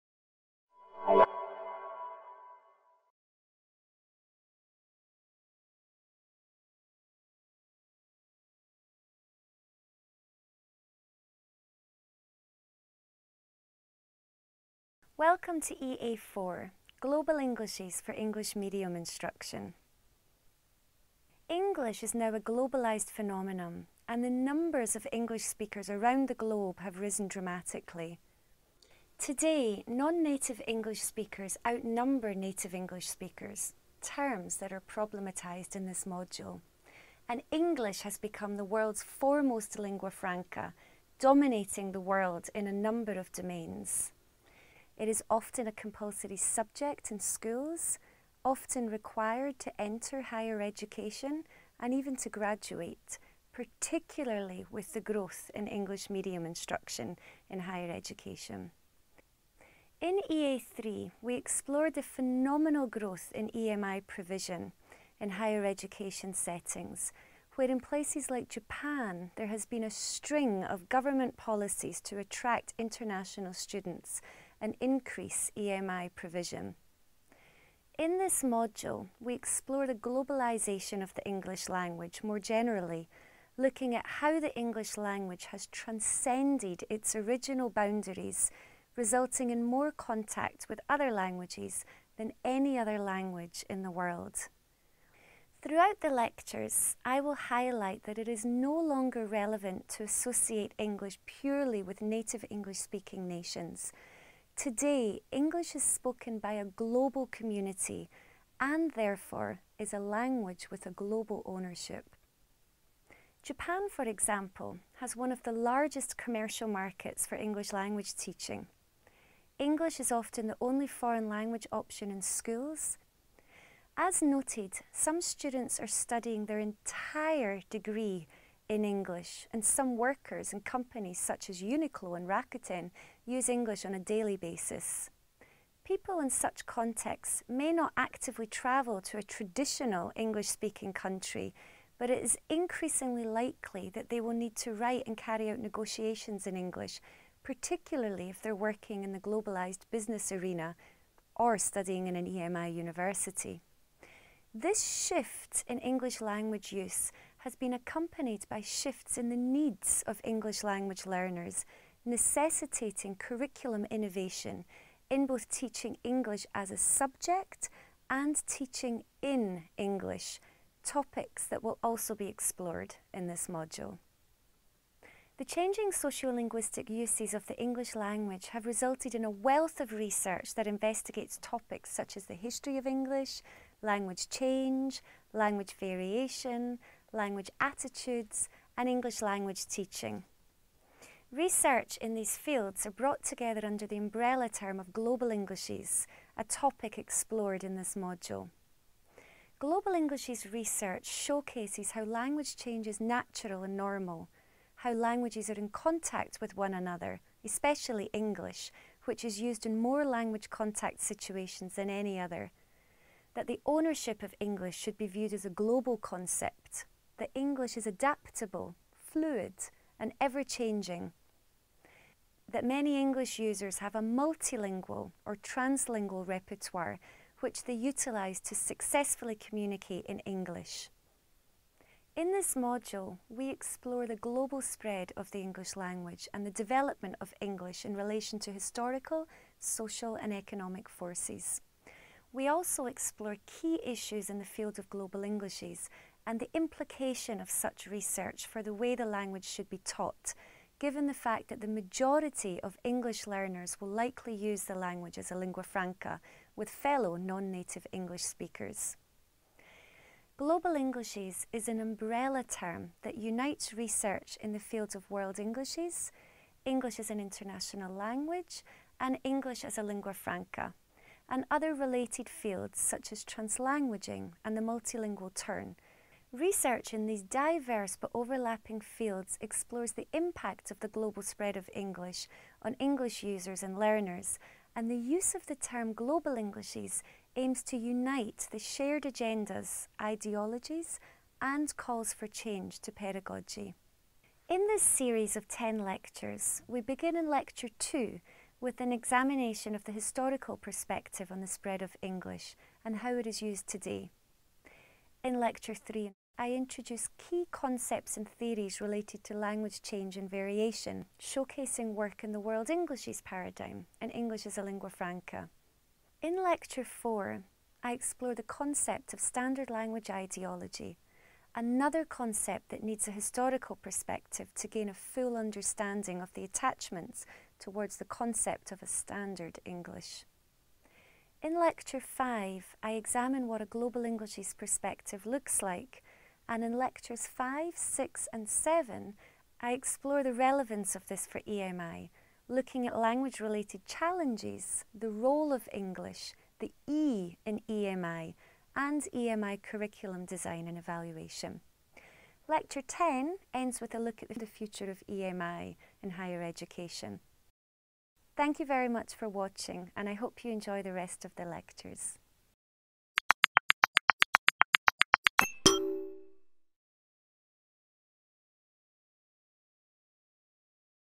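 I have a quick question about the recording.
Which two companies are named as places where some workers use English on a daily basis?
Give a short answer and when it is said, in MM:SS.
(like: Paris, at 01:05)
Uniqlo and Rakuten, at 02:11.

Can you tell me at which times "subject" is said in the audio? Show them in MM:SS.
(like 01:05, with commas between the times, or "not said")
00:46, 02:46.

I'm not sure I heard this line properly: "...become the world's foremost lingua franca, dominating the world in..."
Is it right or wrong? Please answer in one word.
right.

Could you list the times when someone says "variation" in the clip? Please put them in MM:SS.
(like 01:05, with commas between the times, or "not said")
03:05, 05:10.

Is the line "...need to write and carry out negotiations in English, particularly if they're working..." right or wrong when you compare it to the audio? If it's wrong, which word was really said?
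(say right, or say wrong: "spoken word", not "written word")
right.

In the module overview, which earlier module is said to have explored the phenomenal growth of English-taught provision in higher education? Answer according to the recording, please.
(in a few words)
EA3.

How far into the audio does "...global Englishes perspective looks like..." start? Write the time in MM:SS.
05:33.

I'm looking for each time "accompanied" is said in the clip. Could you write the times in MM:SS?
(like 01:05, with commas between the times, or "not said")
02:37.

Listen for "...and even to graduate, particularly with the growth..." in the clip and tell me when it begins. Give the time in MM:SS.
00:51.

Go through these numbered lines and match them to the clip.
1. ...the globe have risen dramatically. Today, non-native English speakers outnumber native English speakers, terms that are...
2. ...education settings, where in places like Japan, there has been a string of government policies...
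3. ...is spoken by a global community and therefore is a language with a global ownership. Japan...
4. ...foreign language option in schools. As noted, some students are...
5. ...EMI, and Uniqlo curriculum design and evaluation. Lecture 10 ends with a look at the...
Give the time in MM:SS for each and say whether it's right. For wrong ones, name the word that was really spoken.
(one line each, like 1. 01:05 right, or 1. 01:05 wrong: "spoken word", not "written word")
1. 00:26 right
2. 01:05 right
3. 01:45 right
4. 02:00 right
5. 05:47 wrong: "EMI", not "Uniqlo".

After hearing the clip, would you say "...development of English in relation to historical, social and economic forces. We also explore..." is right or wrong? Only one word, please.
right.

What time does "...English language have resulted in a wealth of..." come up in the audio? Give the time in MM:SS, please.
02:57.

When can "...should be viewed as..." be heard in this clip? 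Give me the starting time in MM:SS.
03:34.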